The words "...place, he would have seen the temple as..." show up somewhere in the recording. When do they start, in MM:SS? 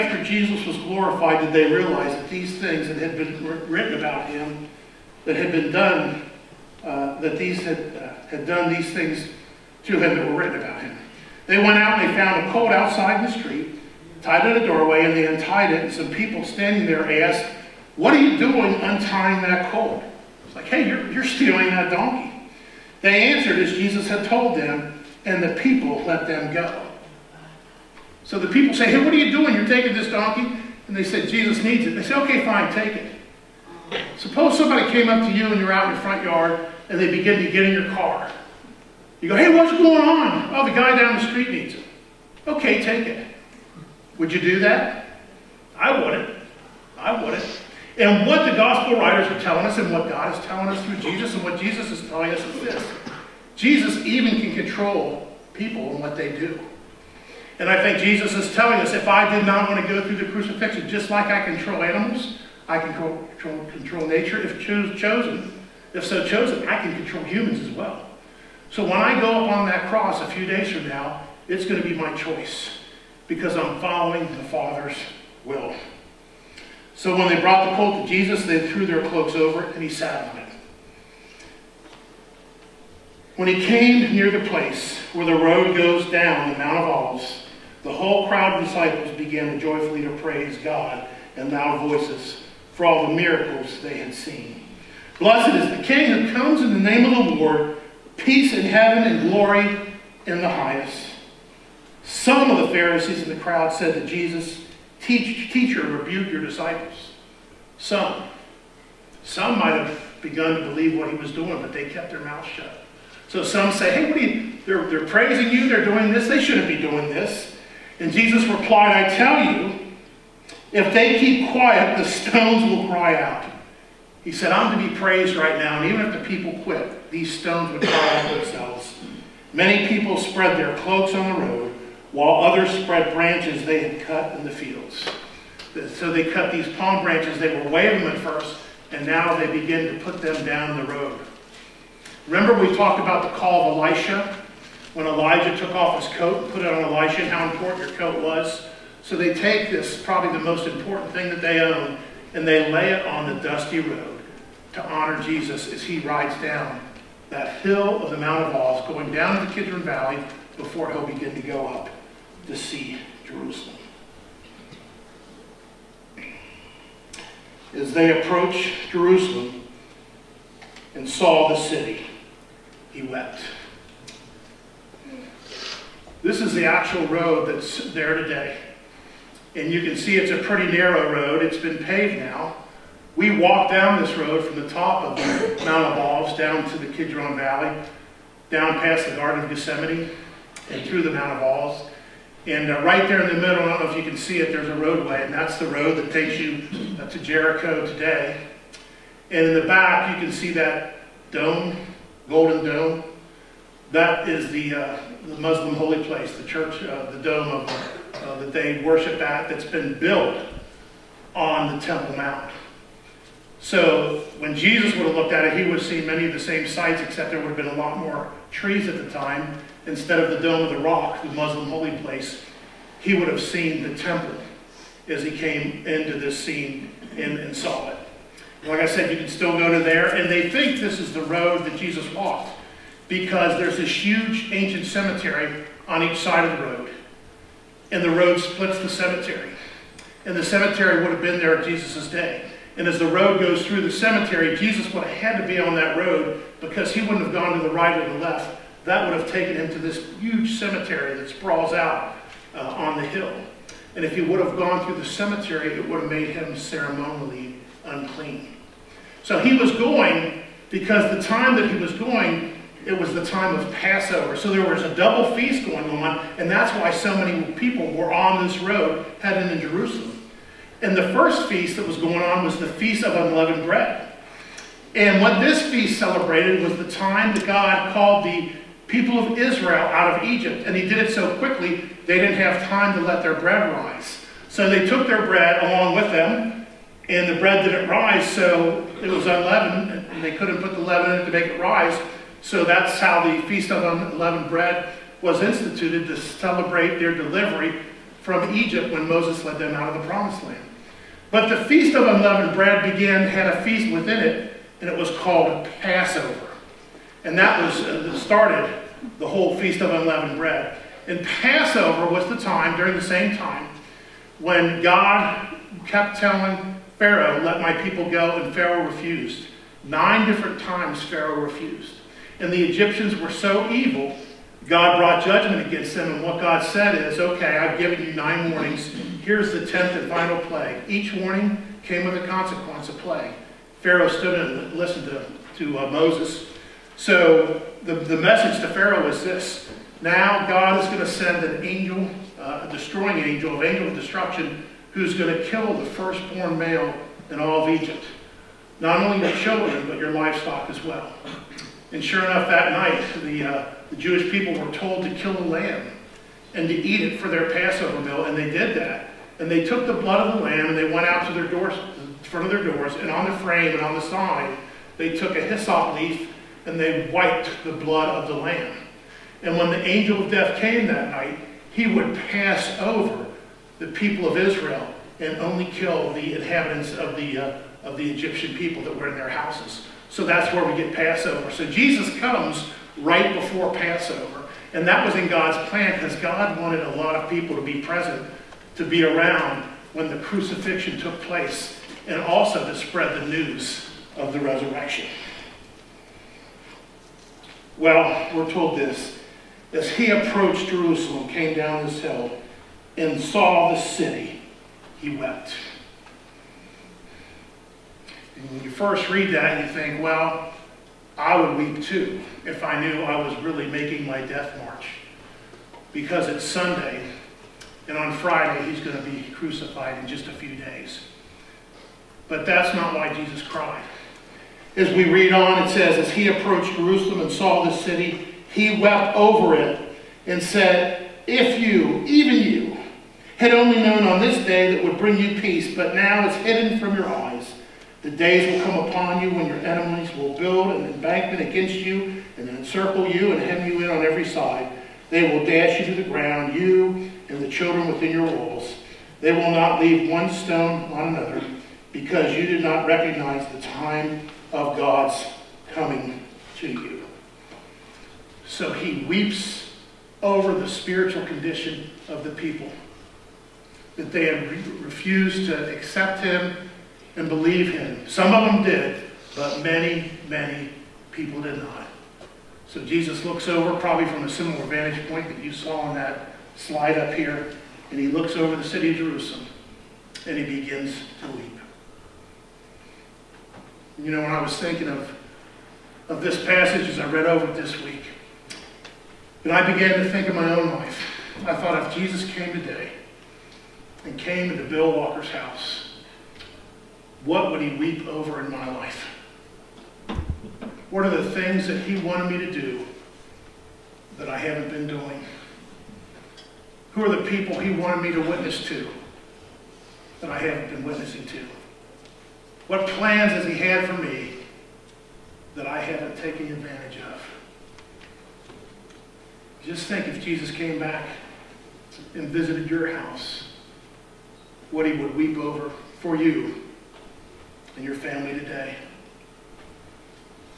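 03:41.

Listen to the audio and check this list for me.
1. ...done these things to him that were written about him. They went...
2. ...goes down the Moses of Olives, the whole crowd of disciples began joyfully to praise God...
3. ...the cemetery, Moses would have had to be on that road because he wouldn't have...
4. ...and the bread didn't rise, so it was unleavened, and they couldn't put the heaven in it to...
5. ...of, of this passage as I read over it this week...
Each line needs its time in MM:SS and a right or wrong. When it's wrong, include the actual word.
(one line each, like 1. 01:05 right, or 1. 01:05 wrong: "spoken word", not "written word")
1. 00:08 right
2. 01:25 wrong: "Mount", not "Moses"
3. 04:03 wrong: "Jesus", not "Moses"
4. 04:47 wrong: "leaven", not "heaven"
5. 08:04 right.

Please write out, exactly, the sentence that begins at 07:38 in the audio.
So he weeps over the spiritual condition of the people that they had re refused to accept him and believe him.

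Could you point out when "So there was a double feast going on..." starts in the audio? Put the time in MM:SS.
04:24.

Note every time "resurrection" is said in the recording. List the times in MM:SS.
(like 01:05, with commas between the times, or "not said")
06:34.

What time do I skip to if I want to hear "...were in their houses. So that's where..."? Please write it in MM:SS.
06:18.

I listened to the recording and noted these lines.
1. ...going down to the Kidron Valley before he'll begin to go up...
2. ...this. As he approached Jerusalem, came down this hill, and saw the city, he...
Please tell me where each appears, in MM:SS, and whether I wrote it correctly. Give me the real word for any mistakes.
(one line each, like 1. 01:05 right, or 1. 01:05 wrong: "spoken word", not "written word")
1. 02:38 right
2. 06:38 right.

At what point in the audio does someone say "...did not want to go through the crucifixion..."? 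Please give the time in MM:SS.
00:59.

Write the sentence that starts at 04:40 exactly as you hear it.
And he did it so quickly, they didn't have time to let their bread rise.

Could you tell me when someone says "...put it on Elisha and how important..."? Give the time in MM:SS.
02:26.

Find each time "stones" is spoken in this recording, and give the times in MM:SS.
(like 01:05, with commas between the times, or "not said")
02:02, 02:07, 07:30.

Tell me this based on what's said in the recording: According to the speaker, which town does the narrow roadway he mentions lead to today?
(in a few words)
Jericho.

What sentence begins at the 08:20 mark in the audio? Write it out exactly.
What are the things that he wanted me to do that I haven't been doing?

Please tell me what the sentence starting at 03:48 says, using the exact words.
Like I said, you can still go to there.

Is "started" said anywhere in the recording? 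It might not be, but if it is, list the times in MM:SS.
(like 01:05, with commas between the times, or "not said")
05:08.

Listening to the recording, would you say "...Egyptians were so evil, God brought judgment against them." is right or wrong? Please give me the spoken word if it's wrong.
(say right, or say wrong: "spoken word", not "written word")
right.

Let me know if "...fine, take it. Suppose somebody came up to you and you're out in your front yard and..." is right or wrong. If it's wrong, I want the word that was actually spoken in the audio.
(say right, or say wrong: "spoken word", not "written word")
right.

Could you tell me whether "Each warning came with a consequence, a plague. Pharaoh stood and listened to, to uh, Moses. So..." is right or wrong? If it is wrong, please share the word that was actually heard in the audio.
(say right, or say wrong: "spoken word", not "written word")
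right.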